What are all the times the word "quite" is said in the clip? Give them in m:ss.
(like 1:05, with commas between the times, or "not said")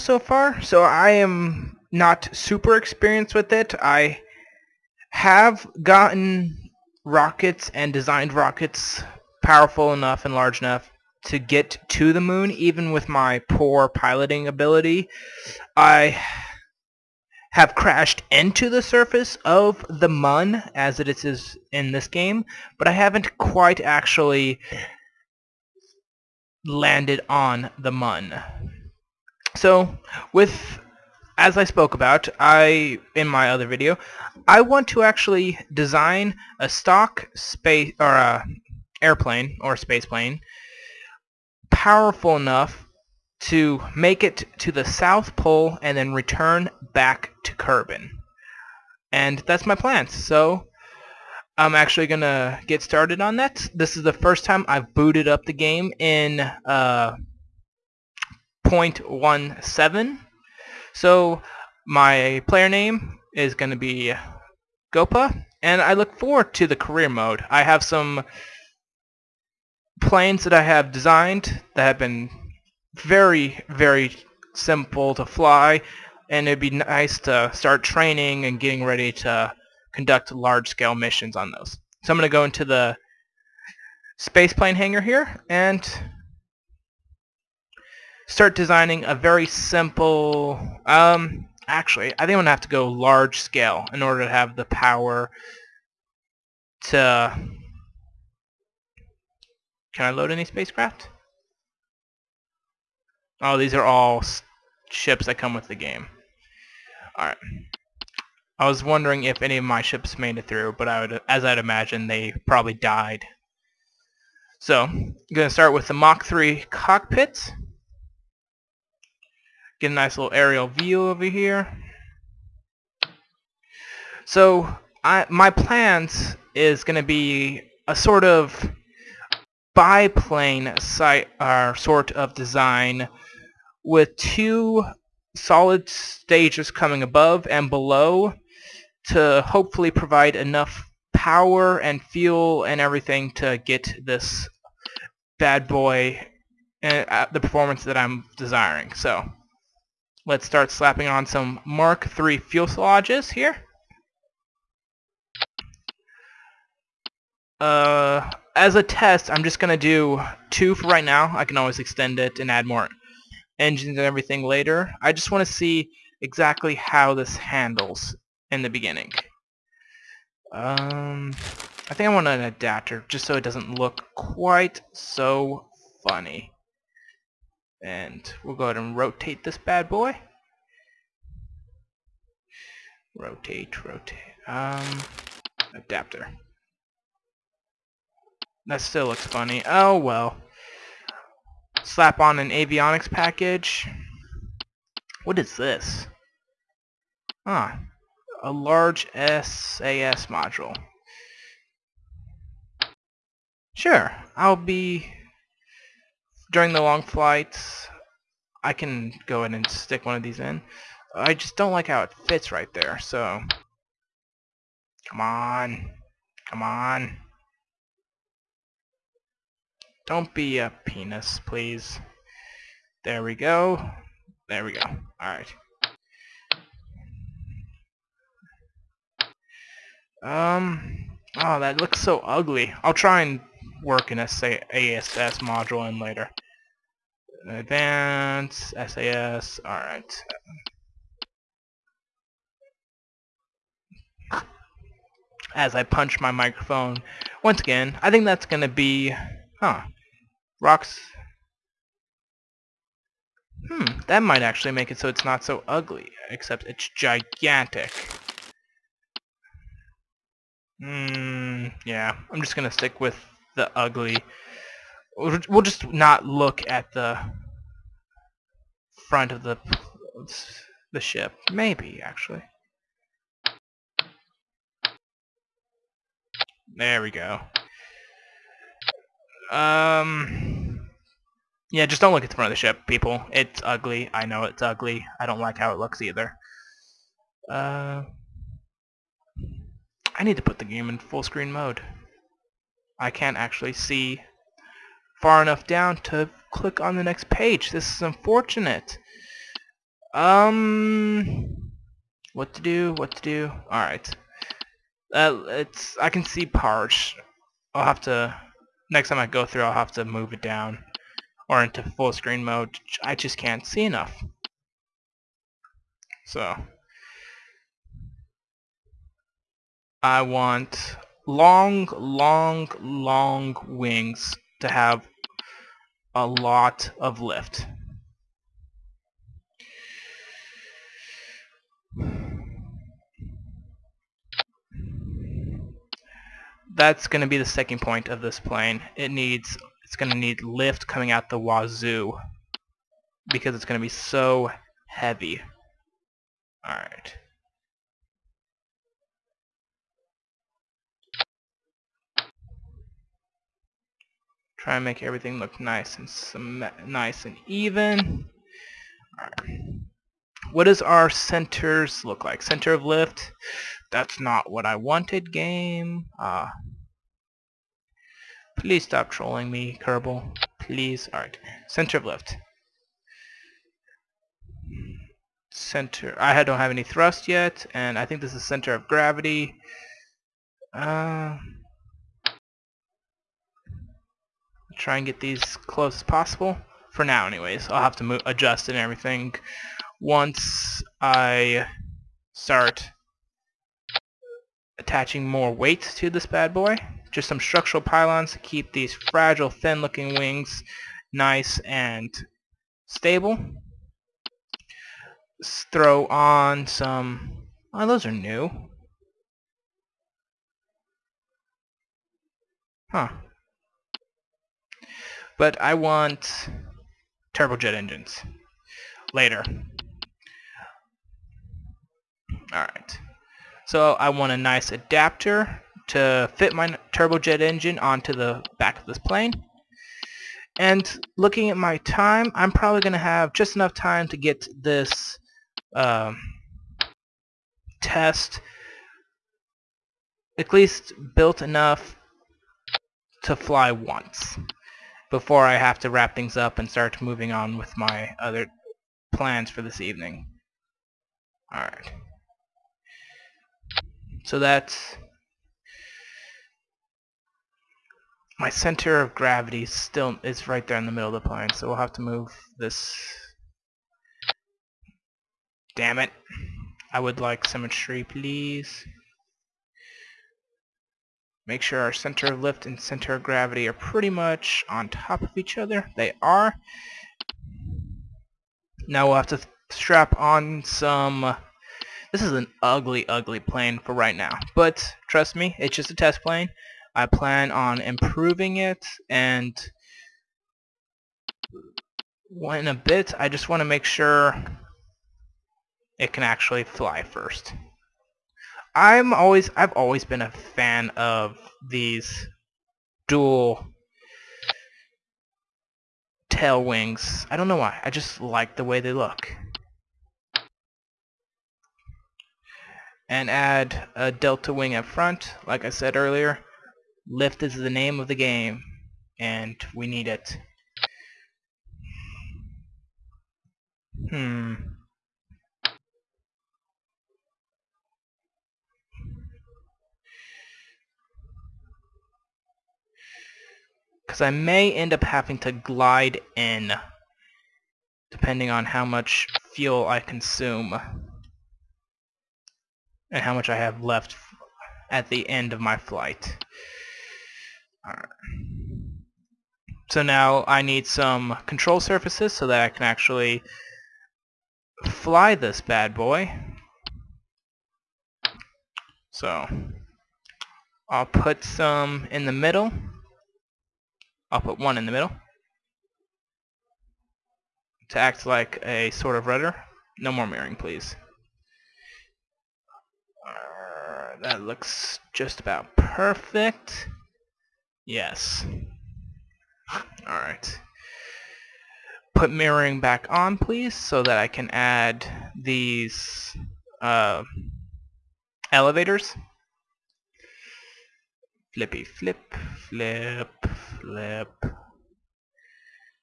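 0:23, 2:54.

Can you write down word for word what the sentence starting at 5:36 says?
That's going to be the second point of this plane.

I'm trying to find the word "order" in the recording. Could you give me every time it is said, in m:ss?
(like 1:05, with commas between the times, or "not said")
1:34.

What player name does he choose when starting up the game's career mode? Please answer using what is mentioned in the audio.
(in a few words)
Gopa.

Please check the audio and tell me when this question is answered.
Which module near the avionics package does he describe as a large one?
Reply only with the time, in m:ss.
3:19.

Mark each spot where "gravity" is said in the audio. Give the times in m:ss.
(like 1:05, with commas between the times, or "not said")
6:18, 7:39, 7:53.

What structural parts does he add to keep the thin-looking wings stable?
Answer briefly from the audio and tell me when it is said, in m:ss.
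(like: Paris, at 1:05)
structural pylons, at 6:37.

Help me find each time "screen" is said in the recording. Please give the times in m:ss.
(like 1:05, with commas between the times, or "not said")
4:51, 5:12.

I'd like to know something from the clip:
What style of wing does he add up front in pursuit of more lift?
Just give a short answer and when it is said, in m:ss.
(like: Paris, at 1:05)
delta wing, at 8:34.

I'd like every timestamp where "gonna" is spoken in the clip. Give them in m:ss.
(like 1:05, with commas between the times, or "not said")
4:08, 4:22.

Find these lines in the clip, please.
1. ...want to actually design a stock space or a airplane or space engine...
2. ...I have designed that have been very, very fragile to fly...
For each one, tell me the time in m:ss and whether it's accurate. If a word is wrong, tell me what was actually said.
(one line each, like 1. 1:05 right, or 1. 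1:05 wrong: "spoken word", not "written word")
1. 0:34 wrong: "plane", not "engine"
2. 1:10 wrong: "simple", not "fragile".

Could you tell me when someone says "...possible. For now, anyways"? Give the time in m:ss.
6:26.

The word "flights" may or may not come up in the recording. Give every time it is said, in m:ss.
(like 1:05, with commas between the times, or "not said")
3:27, 9:05.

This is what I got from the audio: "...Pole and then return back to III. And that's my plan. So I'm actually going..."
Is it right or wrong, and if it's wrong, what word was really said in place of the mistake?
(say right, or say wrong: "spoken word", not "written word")
wrong: "Kerbin", not "III".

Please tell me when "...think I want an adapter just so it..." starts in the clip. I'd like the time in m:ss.
2:51.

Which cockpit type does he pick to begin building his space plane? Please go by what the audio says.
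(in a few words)
Mark 3.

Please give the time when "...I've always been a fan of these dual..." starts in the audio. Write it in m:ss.
8:19.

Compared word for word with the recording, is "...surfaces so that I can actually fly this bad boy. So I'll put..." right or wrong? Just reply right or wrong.
right.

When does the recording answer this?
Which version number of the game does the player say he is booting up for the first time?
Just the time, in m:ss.
0:58.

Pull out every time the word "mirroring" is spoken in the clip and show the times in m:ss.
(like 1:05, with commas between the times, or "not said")
9:30, 9:42.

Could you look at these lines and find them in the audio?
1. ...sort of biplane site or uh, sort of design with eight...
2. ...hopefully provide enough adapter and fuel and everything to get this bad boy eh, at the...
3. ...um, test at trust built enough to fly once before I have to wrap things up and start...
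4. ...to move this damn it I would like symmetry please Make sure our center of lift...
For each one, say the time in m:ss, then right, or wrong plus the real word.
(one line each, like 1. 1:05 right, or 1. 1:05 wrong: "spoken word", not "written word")
1. 2:07 wrong: "two", not "eight"
2. 2:19 wrong: "power", not "adapter"
3. 7:15 wrong: "least", not "trust"
4. 7:41 right.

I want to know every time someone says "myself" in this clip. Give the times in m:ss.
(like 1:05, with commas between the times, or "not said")
not said.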